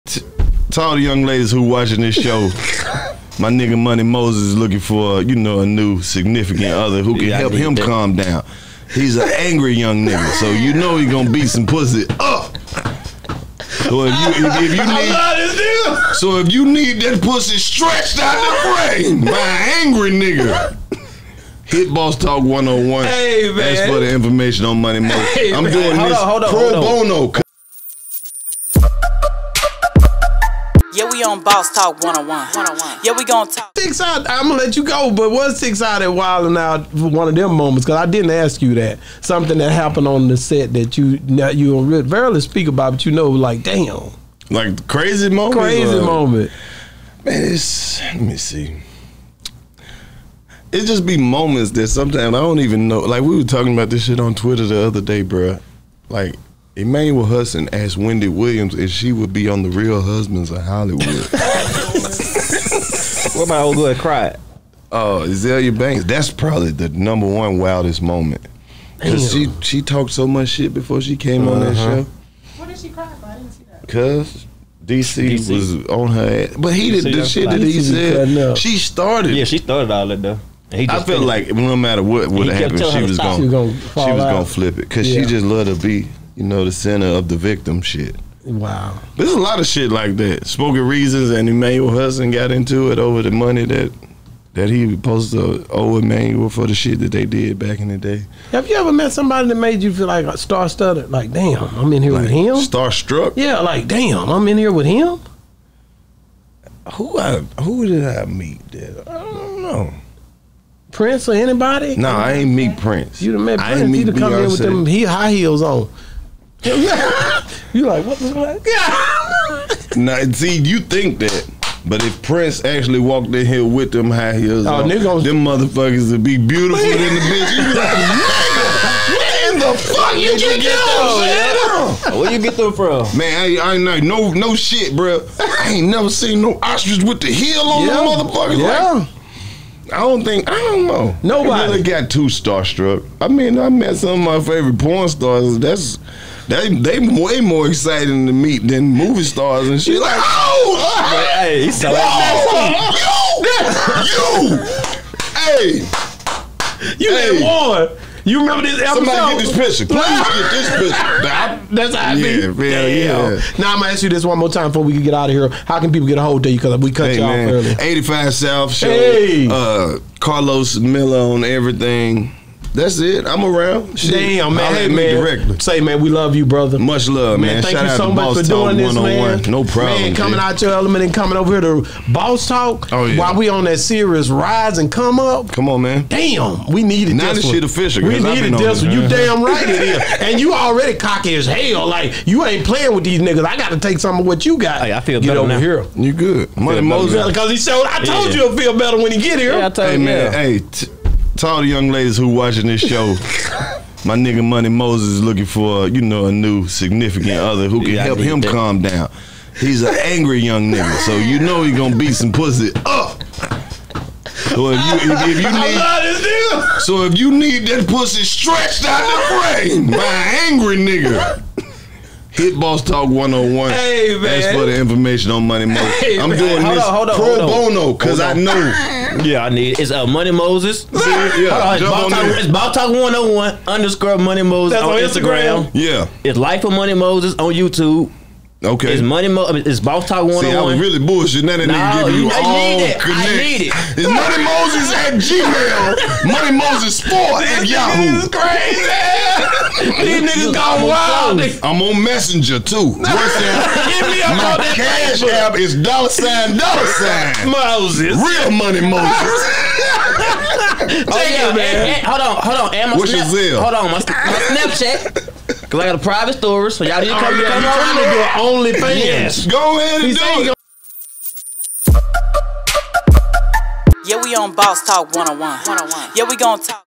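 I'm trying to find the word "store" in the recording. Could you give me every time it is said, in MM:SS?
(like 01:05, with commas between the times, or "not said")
04:26.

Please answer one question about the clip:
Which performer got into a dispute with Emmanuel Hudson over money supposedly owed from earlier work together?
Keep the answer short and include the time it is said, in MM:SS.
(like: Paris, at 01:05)
Spoken Reasons, at 01:30.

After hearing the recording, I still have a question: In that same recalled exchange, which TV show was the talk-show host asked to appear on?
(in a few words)
Real Husbands of Hollywood.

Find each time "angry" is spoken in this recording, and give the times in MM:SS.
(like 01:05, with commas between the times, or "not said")
00:09, 00:19, 03:30, 03:40.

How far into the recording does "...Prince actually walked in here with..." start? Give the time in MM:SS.
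02:02.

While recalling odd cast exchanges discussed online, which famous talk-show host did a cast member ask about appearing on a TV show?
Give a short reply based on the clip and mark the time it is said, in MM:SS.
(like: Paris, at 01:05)
Wendy Williams, at 00:57.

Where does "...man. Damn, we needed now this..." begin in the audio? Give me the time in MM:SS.
03:05.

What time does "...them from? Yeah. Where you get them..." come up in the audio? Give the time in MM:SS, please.
02:10.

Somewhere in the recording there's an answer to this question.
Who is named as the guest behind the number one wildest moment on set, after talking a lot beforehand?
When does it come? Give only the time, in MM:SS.
01:05.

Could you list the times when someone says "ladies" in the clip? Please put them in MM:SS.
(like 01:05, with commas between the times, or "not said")
00:01, 03:21.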